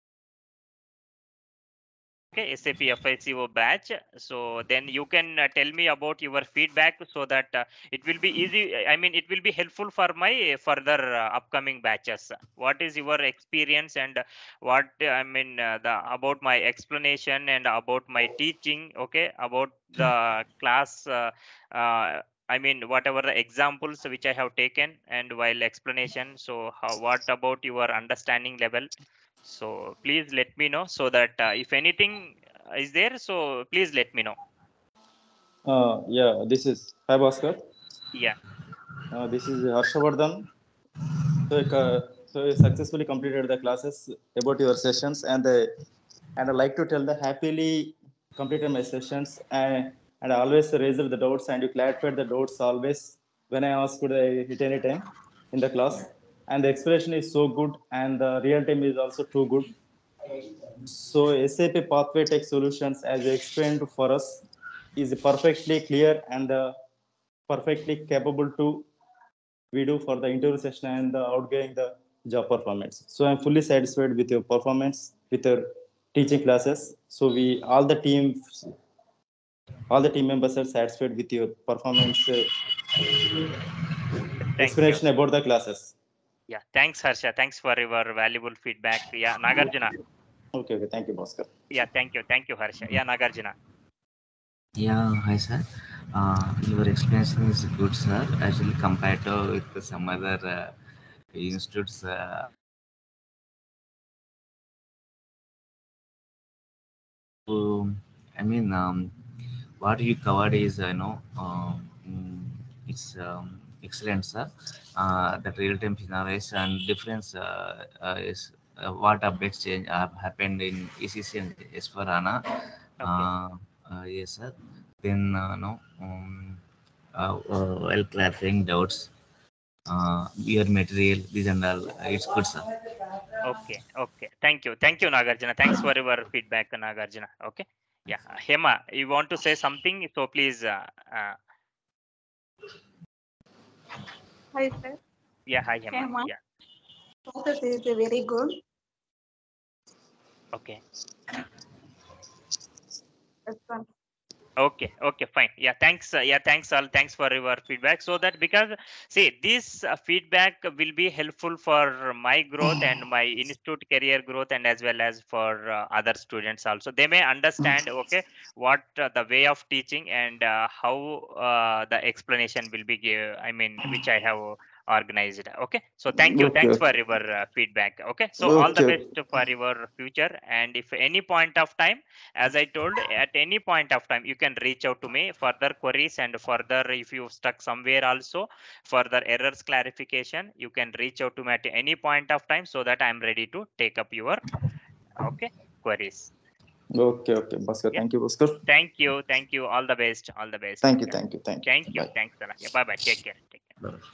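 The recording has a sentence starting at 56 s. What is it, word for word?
And the expression is so good and the real time is also too good.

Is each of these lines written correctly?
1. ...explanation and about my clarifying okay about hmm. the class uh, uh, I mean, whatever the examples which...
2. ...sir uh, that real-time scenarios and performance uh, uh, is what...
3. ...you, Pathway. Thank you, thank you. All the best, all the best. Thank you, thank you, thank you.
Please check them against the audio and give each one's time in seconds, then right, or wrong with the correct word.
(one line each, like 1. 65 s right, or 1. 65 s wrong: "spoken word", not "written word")
1. 16 s wrong: "teaching", not "clarifying"
2. 114 s wrong: "difference", not "performance"
3. 198 s wrong: "Bhaskar", not "Pathway".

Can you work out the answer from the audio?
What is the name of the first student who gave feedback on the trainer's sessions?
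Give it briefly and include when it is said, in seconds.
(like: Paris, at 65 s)
Harshavardhan, at 39 s.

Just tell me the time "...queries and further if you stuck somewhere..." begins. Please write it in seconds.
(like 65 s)
185 s.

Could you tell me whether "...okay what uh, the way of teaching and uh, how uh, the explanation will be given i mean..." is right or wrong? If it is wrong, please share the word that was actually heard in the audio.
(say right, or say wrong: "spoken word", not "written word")
right.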